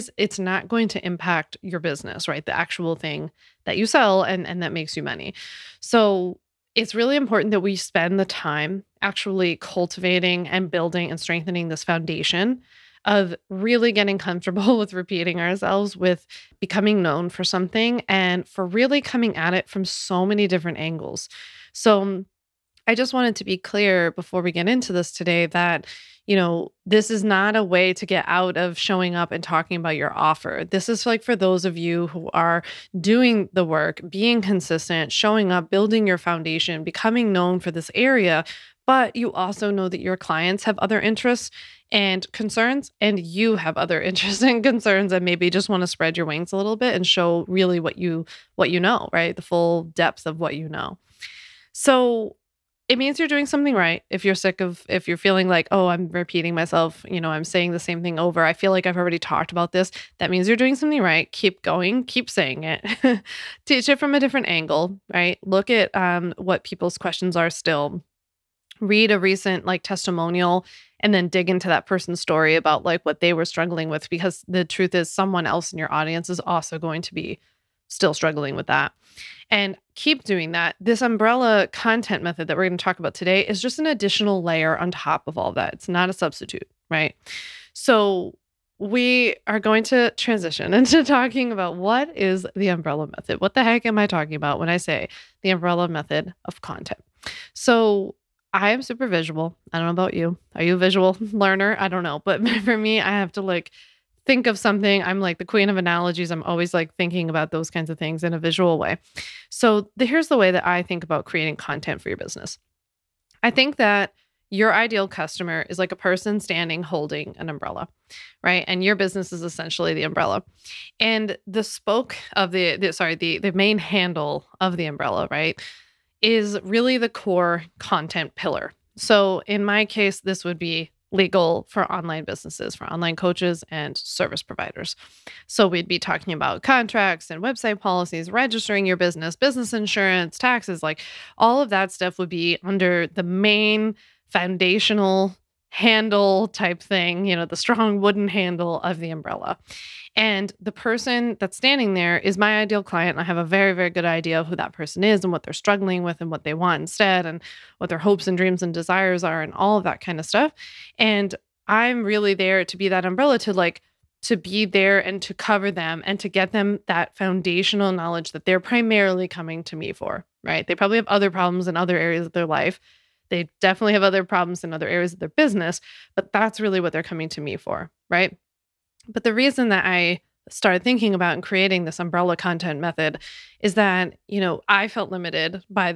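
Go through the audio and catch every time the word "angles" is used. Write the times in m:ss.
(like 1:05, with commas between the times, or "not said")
0:20, 1:04.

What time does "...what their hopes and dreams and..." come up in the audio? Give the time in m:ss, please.
2:37.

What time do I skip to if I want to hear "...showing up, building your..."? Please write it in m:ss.
0:35.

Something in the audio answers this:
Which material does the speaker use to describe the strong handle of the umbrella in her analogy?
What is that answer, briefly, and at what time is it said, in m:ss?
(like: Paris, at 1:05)
Wooden, at 2:27.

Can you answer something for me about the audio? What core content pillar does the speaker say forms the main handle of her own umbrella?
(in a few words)
Legal for online businesses.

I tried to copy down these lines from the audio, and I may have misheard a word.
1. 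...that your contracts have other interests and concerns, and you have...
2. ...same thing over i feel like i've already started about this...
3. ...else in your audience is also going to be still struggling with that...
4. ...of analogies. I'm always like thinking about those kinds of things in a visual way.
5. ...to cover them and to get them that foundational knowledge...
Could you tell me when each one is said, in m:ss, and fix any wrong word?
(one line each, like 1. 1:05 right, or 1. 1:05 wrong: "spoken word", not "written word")
1. 0:39 wrong: "clients", not "contracts"
2. 0:57 wrong: "talked", not "started"
3. 1:15 right
4. 1:45 right
5. 2:45 right.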